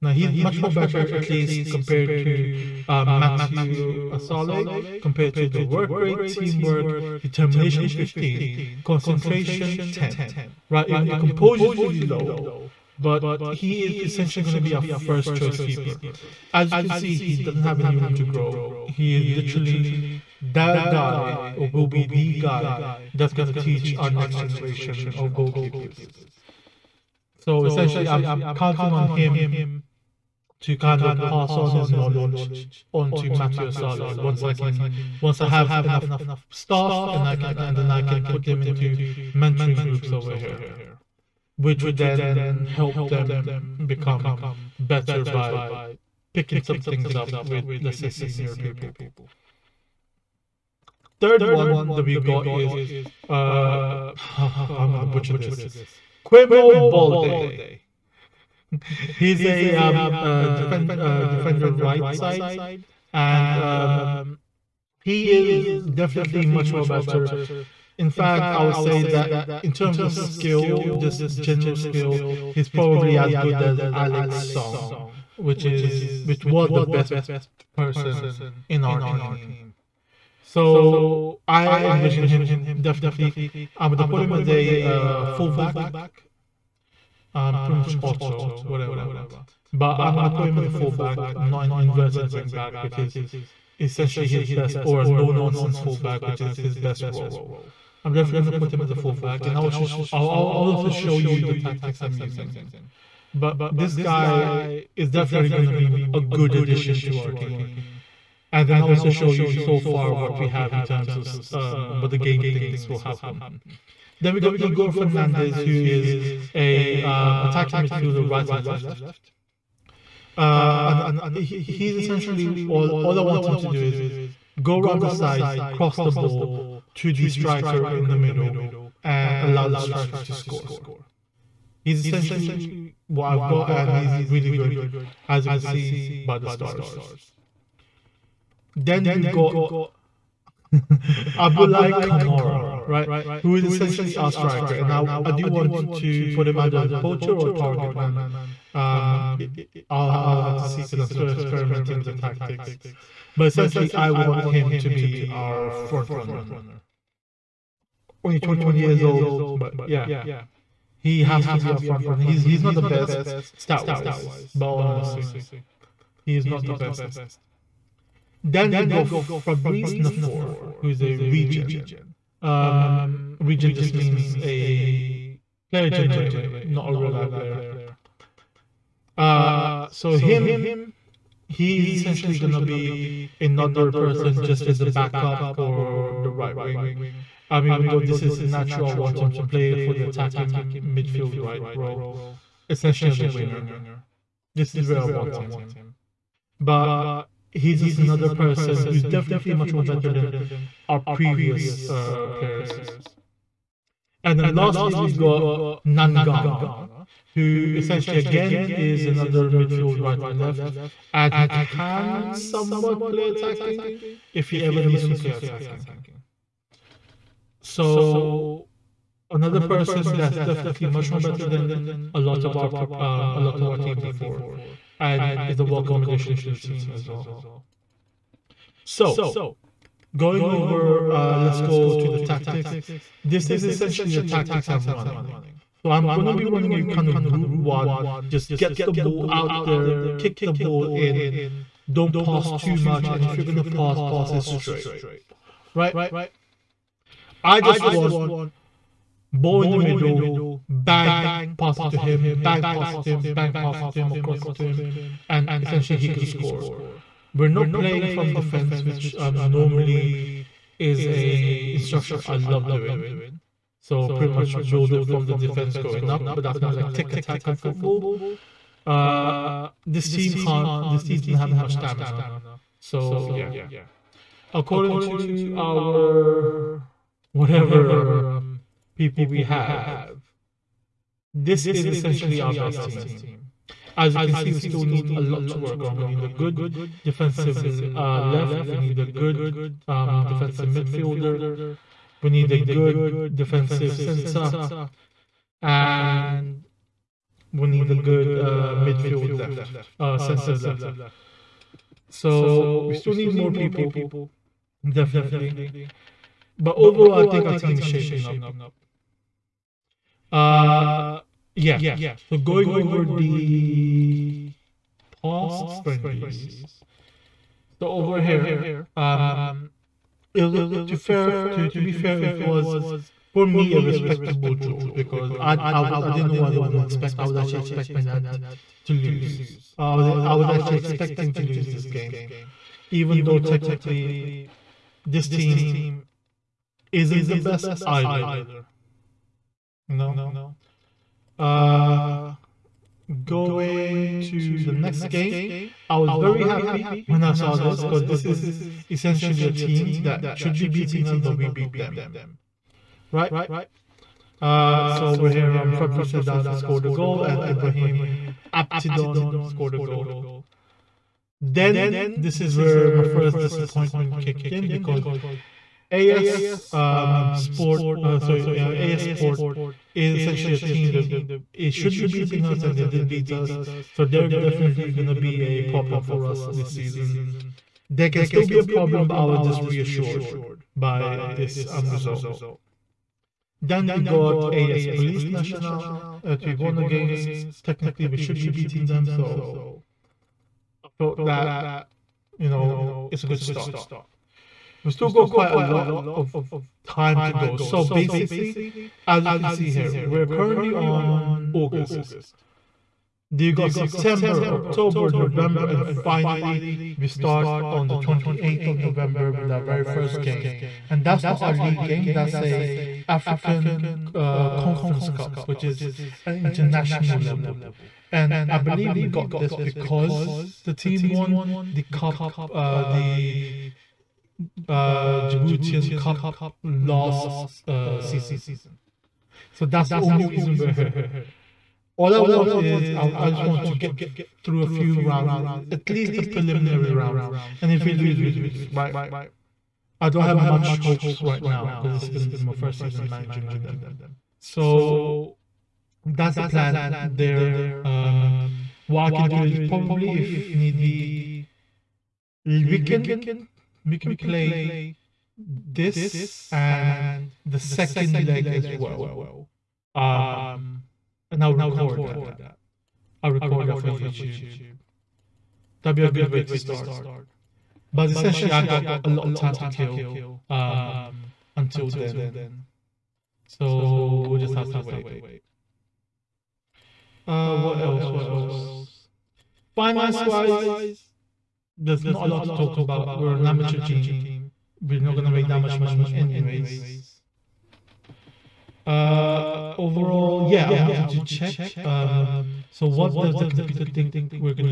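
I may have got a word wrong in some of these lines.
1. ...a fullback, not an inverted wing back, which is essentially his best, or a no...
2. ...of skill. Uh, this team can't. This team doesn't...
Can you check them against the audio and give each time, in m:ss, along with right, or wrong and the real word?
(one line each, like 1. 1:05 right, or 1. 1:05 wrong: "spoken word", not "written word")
1. 1:30 right
2. 4:27 wrong: "football", not "skill".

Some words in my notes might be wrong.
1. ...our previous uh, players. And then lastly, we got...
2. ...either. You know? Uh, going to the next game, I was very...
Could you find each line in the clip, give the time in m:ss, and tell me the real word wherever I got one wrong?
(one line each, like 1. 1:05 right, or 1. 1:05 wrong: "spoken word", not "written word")
1. 3:20 right
2. 5:37 right.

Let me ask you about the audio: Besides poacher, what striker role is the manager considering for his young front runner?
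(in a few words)
Target man.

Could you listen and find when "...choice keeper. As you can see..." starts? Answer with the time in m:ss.
0:15.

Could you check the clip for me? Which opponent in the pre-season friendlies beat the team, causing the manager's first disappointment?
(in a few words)
AS Sport.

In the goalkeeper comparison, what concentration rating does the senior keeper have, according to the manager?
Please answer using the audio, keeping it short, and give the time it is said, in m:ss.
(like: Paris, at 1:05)
10, at 0:08.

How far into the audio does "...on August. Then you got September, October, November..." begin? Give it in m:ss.
6:40.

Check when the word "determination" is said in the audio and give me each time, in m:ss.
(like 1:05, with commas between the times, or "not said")
0:07.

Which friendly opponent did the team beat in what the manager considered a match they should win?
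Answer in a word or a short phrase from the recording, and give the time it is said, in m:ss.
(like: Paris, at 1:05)
AS Police National, at 6:24.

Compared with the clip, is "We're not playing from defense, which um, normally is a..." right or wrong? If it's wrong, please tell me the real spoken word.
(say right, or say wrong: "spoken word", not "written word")
right.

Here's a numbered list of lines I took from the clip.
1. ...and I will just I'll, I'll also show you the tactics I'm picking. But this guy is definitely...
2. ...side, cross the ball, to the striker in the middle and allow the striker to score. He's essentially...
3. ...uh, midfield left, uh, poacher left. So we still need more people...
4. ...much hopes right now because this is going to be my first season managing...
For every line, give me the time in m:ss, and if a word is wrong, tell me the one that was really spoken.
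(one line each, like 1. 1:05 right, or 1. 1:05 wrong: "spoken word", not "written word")
1. 1:39 wrong: "using", not "picking"
2. 2:05 right
3. 4:58 wrong: "center", not "poacher"
4. 7:20 right.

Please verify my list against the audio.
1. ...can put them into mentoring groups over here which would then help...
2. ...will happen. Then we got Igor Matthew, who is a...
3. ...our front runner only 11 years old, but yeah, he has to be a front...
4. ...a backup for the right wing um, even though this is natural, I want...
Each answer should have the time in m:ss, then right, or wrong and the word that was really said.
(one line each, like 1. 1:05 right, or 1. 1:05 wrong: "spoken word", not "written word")
1. 0:38 right
2. 1:52 wrong: "Fernandez", not "Matthew"
3. 2:35 wrong: "21", not "11"
4. 3:04 right.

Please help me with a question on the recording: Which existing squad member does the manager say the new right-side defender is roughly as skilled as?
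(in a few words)
Alex Song.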